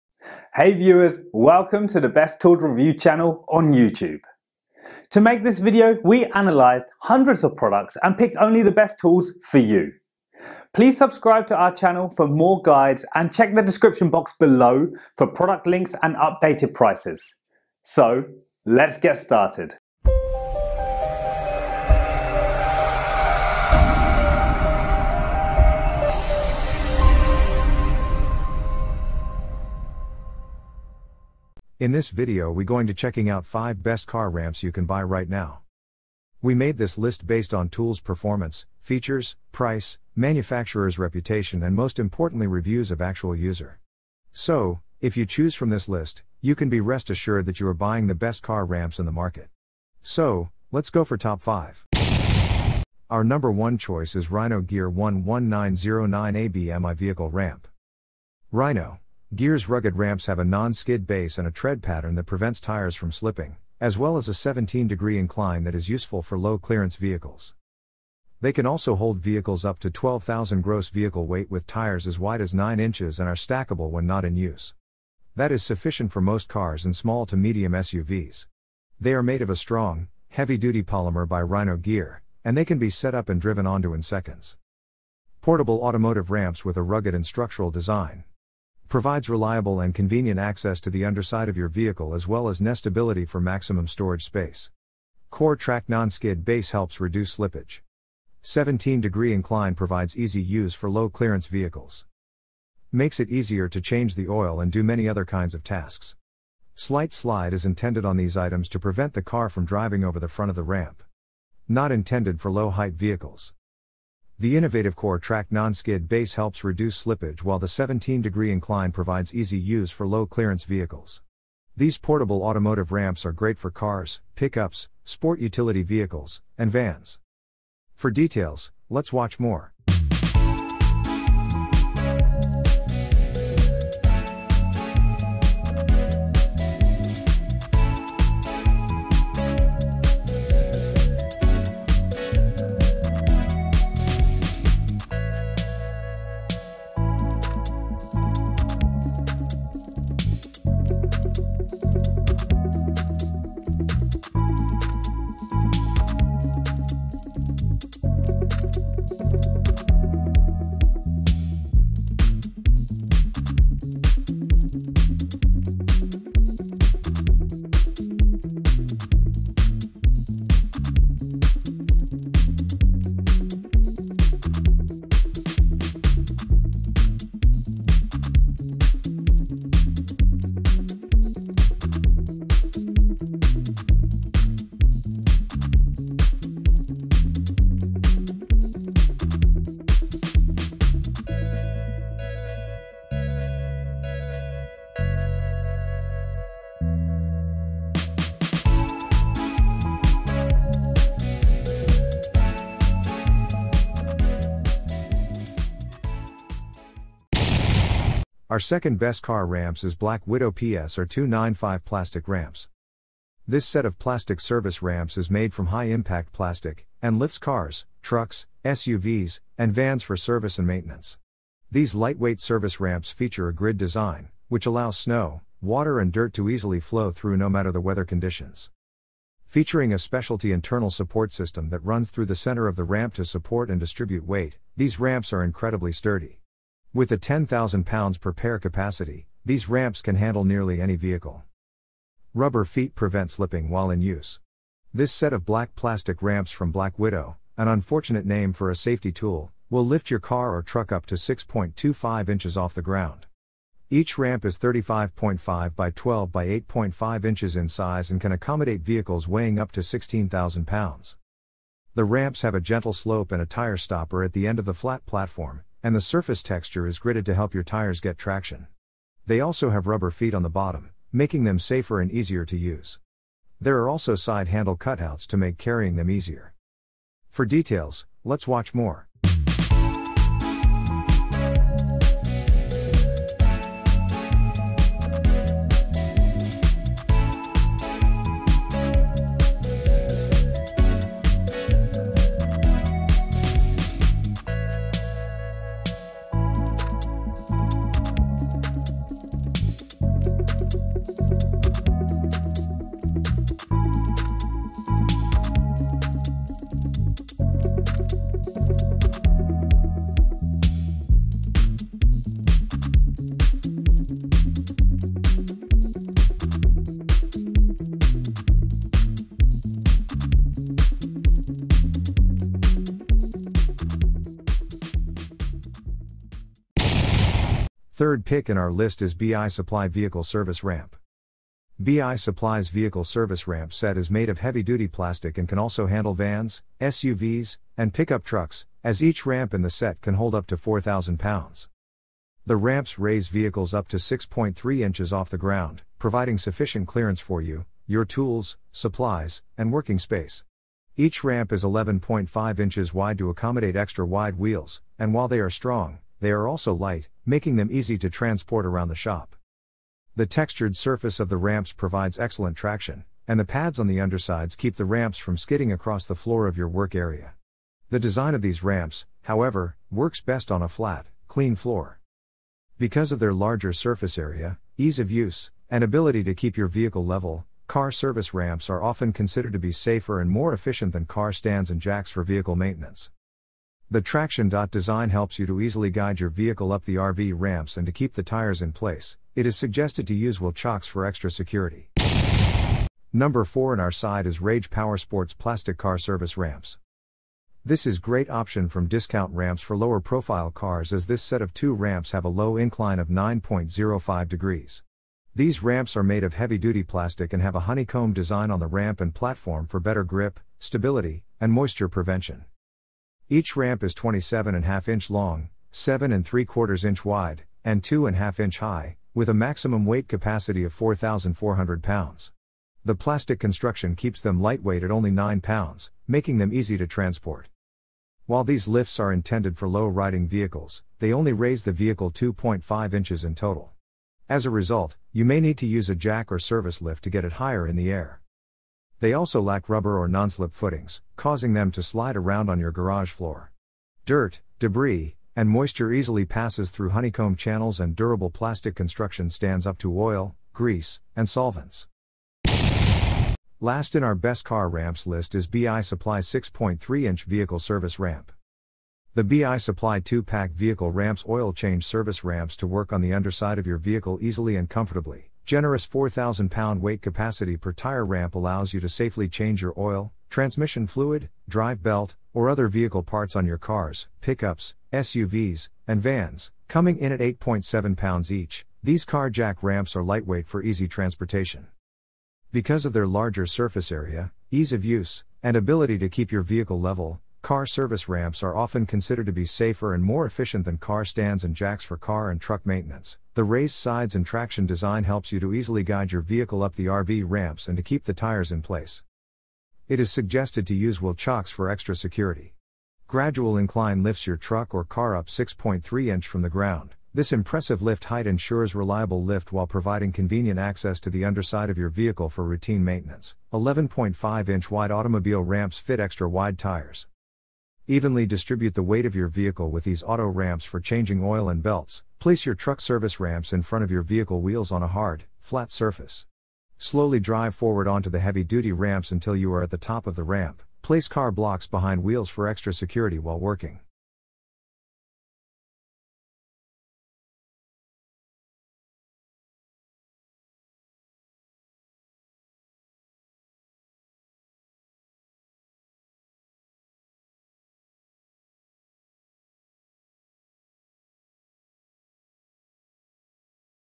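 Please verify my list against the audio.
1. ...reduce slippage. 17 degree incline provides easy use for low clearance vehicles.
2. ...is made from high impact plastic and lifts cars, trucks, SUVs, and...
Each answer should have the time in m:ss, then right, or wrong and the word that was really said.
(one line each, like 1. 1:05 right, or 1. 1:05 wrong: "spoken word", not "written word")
1. 1:36 right
2. 3:35 right.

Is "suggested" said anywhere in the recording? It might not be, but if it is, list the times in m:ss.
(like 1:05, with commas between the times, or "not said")
6:29, 8:20.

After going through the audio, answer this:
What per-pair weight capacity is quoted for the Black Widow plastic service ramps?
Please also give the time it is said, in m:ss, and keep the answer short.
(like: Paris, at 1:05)
10,000 pounds, at 3:57.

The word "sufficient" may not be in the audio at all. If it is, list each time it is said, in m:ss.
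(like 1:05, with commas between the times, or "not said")
1:15, 5:46.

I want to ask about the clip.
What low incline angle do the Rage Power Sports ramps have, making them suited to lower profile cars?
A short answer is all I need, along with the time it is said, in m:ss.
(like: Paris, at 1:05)
9.05 degrees, at 6:43.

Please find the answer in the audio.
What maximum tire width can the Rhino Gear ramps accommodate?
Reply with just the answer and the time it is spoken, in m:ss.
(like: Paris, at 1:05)
9 inches, at 1:12.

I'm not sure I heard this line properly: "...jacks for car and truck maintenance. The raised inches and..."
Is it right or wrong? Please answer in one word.
wrong.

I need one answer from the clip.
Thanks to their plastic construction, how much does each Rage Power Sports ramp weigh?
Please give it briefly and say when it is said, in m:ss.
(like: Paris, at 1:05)
9 pounds, at 7:05.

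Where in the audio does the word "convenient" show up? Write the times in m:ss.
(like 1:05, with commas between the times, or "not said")
1:29, 8:30.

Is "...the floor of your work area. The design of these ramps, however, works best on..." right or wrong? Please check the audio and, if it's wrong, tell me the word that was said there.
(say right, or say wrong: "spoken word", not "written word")
right.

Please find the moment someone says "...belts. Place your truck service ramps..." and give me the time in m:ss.
8:41.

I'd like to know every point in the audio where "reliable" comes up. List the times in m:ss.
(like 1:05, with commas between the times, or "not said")
1:29, 8:28.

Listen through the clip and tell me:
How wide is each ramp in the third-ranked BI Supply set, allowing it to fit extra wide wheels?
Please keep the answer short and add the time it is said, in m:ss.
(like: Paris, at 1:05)
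11.5 inches, at 5:51.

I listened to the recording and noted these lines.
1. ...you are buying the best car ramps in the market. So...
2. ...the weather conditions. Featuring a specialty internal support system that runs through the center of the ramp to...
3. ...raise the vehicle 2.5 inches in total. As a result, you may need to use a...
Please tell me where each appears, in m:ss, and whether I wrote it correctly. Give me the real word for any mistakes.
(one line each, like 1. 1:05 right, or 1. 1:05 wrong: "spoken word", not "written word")
1. 0:47 right
2. 3:47 right
3. 7:11 right.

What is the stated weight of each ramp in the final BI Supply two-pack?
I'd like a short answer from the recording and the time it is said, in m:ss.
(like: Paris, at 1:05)
8.7 pounds, at 7:57.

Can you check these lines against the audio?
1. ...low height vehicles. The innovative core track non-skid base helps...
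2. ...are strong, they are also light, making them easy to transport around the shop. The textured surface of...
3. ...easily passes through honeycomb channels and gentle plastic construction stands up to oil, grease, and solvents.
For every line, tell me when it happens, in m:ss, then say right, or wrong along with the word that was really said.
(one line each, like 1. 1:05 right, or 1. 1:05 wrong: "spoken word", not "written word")
1. 1:52 right
2. 5:55 right
3. 7:25 wrong: "durable", not "gentle".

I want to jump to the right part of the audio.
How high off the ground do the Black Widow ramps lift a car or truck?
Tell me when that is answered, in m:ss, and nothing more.
4:11.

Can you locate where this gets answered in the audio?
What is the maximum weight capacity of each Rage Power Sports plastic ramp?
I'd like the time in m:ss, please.
7:00.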